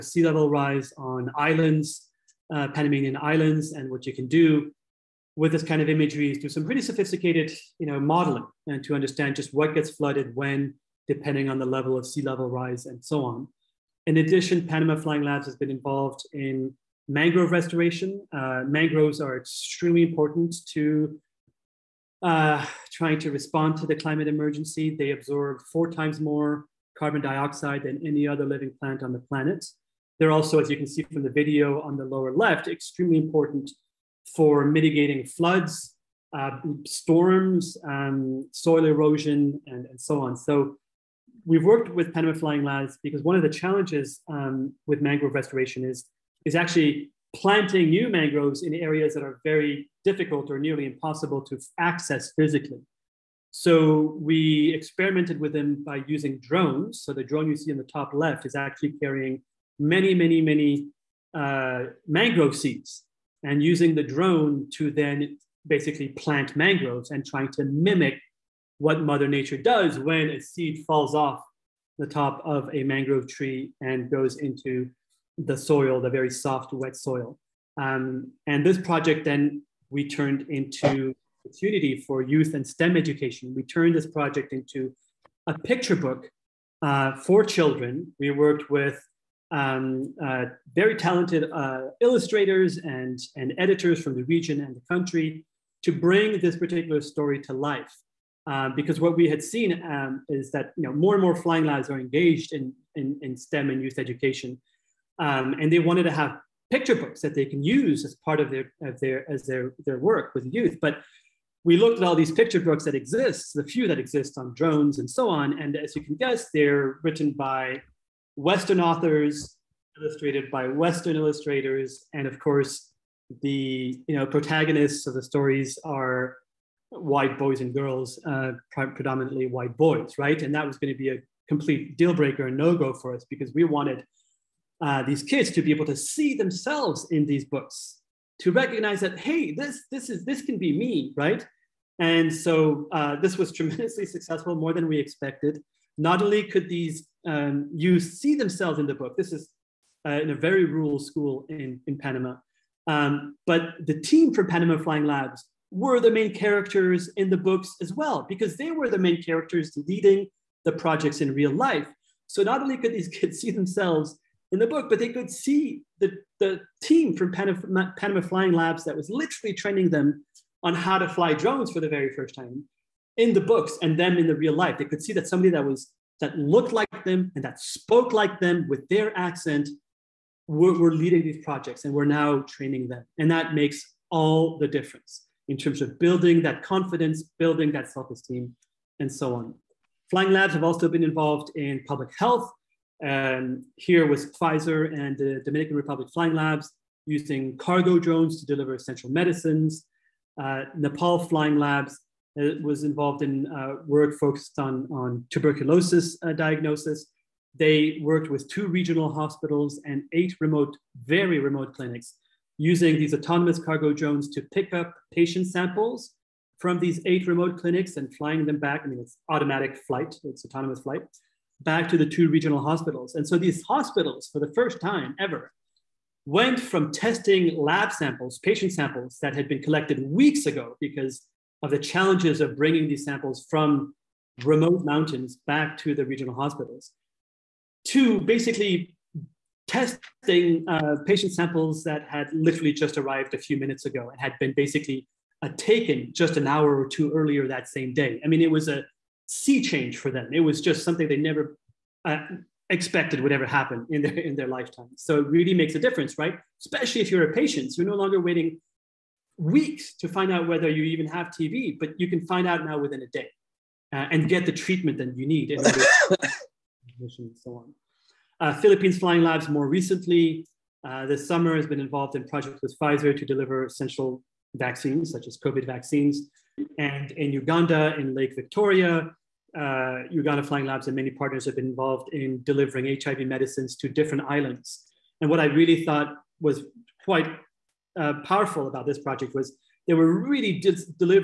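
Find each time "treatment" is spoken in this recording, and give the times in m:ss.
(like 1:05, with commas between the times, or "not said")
4:24.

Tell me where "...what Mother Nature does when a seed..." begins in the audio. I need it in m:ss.
1:08.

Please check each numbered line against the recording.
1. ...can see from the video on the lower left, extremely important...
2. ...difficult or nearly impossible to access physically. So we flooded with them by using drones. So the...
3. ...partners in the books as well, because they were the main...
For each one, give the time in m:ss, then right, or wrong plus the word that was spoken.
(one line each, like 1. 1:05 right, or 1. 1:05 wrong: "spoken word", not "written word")
1. 0:30 right
2. 0:50 wrong: "experimented", not "flooded"
3. 2:36 wrong: "characters", not "partners".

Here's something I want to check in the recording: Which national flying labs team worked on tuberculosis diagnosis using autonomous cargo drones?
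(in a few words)
Nepal Flying Labs.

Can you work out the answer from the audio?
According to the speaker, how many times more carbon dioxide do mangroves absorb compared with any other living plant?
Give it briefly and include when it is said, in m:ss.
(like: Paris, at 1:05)
4 times, at 0:25.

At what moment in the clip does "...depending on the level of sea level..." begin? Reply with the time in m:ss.
0:11.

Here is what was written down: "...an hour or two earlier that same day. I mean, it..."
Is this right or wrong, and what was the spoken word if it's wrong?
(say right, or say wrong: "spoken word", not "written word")
right.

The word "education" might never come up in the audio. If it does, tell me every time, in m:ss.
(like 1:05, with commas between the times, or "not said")
1:22, 1:43.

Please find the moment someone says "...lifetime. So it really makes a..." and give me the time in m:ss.
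4:14.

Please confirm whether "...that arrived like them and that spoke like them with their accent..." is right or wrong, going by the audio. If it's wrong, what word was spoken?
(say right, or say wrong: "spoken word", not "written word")
wrong: "looked", not "arrived".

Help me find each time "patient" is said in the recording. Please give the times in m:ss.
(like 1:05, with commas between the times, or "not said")
3:35, 3:48, 4:01, 4:17.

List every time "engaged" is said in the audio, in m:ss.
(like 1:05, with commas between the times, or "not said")
1:41.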